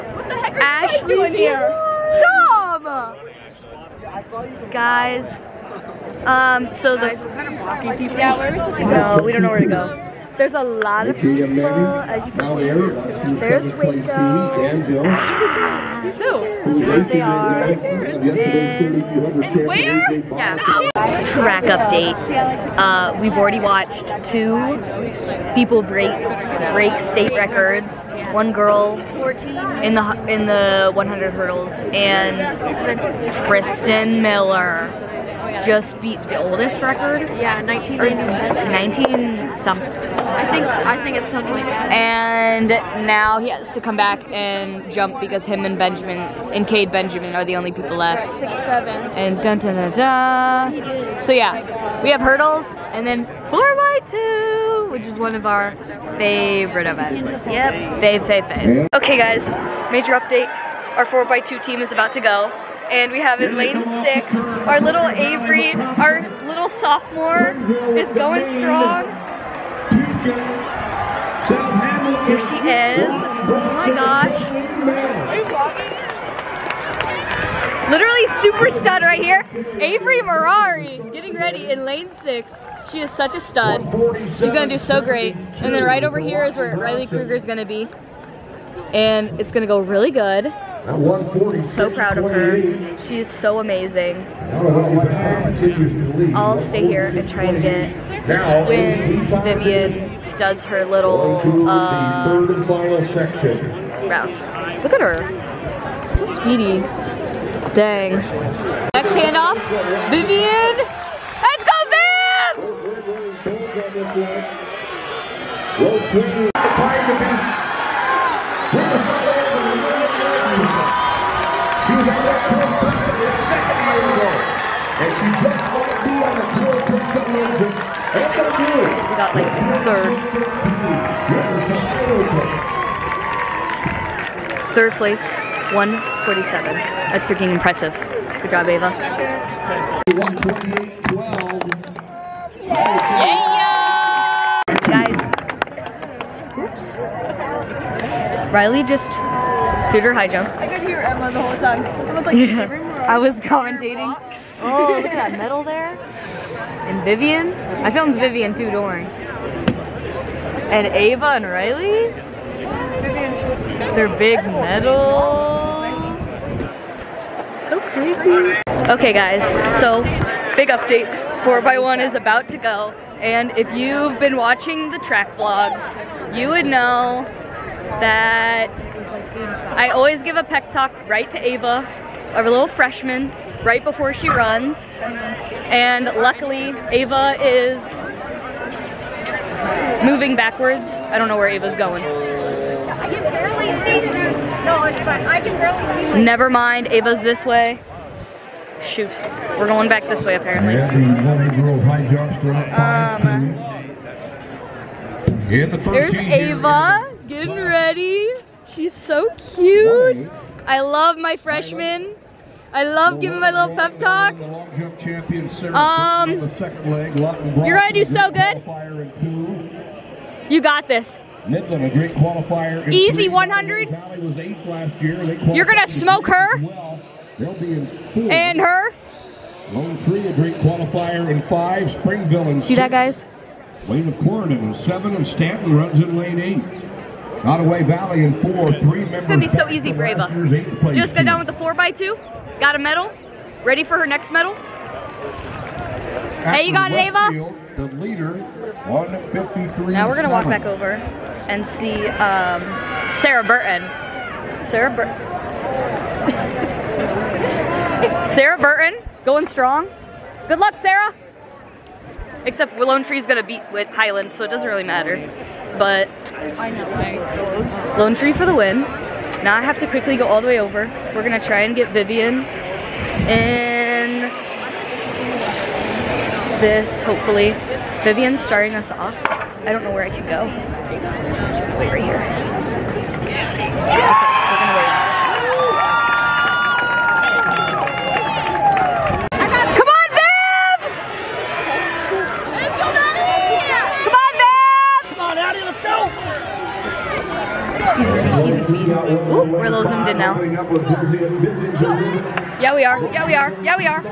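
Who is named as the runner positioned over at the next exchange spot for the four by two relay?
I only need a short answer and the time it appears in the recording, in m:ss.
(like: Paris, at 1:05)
Riley Kruger, at 1:26.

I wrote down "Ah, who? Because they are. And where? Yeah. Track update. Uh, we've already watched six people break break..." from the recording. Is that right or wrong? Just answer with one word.
wrong.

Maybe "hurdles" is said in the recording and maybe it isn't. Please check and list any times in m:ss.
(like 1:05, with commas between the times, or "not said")
0:31, 0:52.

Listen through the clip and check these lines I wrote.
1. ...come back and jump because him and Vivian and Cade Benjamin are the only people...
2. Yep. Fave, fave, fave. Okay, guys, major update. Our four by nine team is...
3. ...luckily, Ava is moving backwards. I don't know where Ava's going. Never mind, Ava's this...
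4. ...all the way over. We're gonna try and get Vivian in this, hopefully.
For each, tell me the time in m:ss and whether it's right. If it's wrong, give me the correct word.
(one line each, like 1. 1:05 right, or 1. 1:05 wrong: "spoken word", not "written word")
1. 0:43 wrong: "Benjamin", not "Vivian"
2. 0:57 wrong: "two", not "nine"
3. 3:06 right
4. 4:30 right.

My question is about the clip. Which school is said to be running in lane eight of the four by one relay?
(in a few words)
Stanton.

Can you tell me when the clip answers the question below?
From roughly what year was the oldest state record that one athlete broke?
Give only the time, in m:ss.
0:37.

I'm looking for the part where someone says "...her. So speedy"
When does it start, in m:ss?
1:44.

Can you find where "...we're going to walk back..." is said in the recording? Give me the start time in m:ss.
4:10.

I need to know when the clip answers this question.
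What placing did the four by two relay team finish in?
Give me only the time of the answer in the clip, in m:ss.
2:14.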